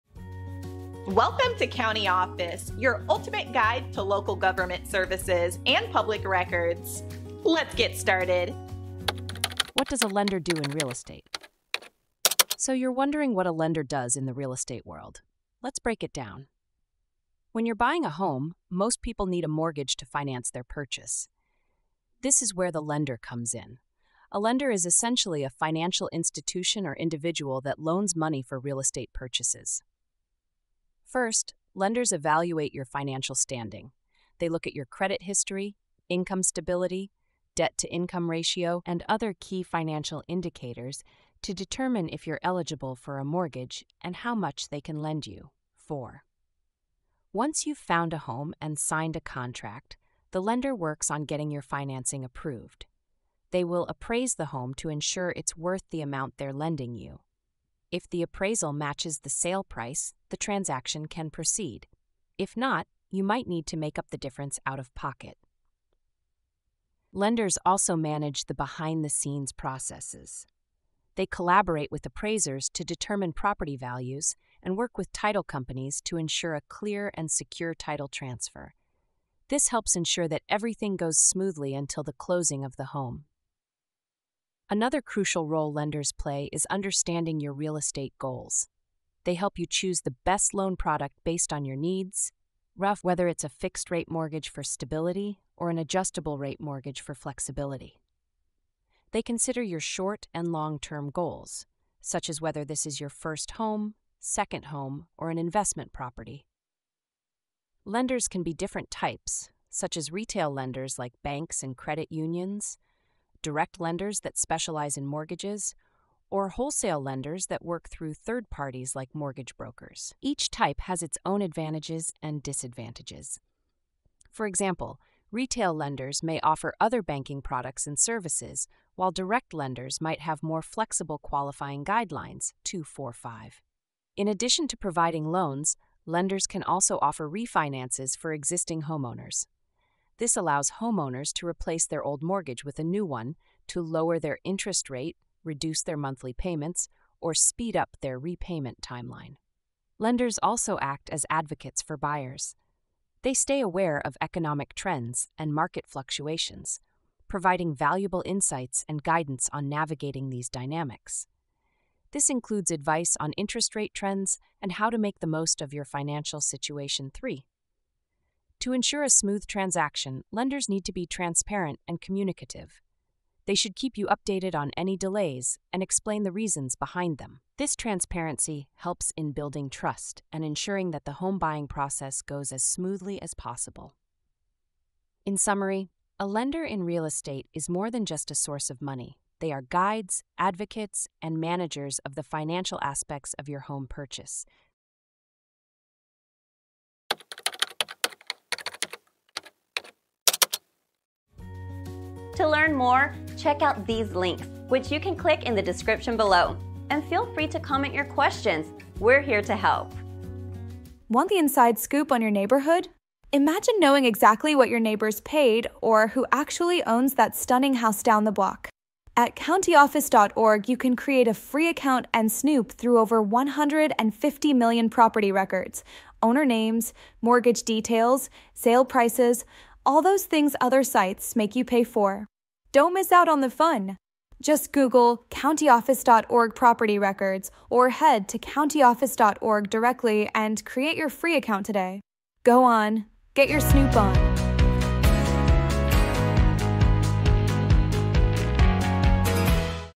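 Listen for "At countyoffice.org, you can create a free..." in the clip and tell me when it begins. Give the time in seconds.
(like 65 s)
219 s.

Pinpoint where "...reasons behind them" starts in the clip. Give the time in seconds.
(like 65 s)
176 s.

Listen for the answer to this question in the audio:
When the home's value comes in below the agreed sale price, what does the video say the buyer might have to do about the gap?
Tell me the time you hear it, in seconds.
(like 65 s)
63 s.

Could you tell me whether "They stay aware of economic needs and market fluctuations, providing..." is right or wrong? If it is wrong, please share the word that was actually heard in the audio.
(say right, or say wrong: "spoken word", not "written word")
wrong: "trends", not "needs".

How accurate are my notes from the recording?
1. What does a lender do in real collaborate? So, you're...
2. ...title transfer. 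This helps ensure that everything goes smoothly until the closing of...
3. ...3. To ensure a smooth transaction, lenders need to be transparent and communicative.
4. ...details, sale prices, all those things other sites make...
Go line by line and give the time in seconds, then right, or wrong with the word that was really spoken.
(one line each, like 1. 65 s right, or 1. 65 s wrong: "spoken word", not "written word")
1. 9 s wrong: "estate", not "collaborate"
2. 77 s right
3. 167 s right
4. 227 s right.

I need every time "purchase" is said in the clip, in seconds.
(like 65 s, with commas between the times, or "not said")
20 s, 29 s, 193 s.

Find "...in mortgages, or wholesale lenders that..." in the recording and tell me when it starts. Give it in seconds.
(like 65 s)
114 s.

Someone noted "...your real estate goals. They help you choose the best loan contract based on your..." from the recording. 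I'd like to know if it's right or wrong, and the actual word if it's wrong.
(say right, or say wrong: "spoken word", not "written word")
wrong: "product", not "contract".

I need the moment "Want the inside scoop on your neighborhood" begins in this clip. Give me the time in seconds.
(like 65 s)
211 s.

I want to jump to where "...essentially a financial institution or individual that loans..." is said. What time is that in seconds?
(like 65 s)
24 s.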